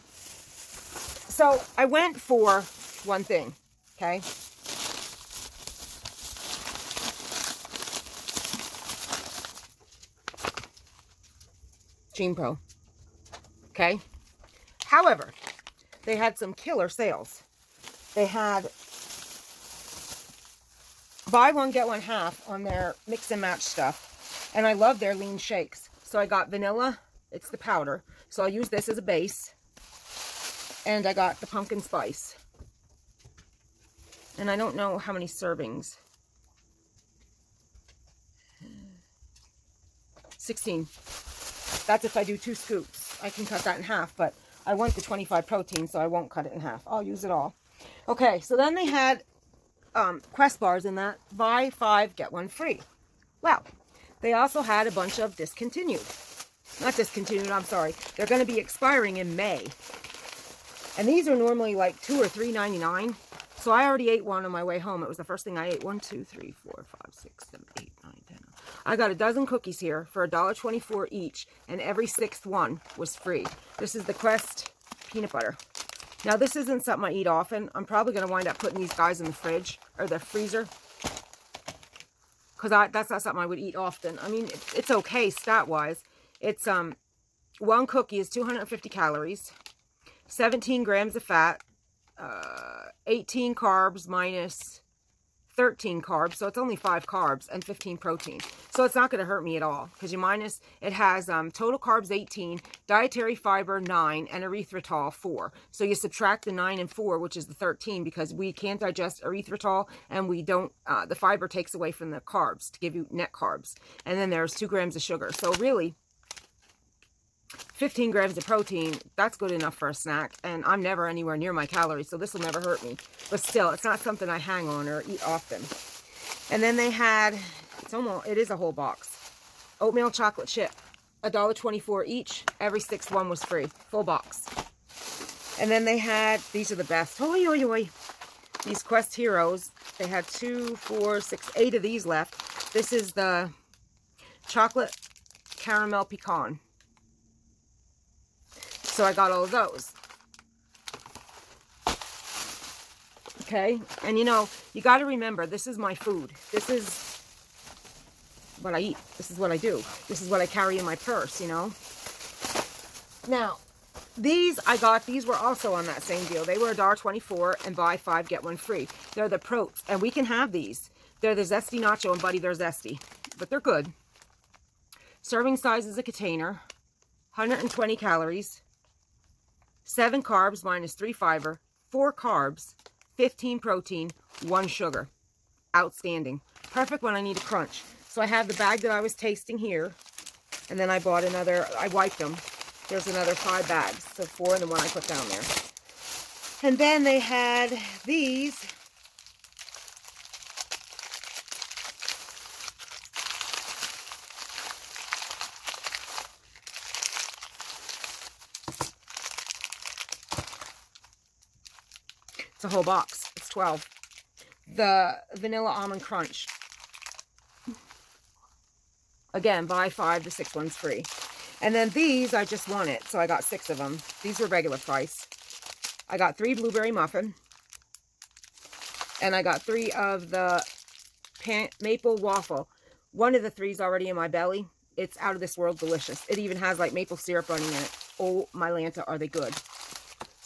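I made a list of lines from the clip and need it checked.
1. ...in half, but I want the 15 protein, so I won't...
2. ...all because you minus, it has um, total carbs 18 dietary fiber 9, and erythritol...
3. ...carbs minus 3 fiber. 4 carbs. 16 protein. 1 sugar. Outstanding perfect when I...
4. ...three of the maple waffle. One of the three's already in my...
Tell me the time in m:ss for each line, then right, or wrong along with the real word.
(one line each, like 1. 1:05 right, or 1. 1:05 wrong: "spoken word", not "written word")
1. 0:43 wrong: "25", not "15"
2. 1:39 right
3. 3:00 wrong: "15", not "16"
4. 3:49 right.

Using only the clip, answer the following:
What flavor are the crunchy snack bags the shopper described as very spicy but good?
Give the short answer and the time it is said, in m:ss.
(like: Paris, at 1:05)
Zesty Nacho, at 2:51.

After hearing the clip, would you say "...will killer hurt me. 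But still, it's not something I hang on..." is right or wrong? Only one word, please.
wrong.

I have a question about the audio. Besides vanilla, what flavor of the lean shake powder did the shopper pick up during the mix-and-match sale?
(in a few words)
pumpkin spice.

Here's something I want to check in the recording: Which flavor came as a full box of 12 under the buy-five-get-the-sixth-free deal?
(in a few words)
Vanilla Almond Crunch.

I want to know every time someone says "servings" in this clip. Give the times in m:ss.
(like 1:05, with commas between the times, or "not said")
0:35, 2:55.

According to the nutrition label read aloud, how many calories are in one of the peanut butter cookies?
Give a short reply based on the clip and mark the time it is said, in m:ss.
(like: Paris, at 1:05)
250, at 1:28.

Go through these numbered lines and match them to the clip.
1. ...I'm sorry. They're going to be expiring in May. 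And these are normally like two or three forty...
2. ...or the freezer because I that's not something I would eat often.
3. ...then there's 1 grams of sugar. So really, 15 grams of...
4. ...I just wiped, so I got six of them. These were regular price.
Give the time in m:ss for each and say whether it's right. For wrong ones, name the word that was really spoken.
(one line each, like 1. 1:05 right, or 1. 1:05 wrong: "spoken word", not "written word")
1. 0:57 wrong: "ninety", not "forty"
2. 1:19 right
3. 1:54 wrong: "2", not "1"
4. 3:42 wrong: "wanted", not "wiped".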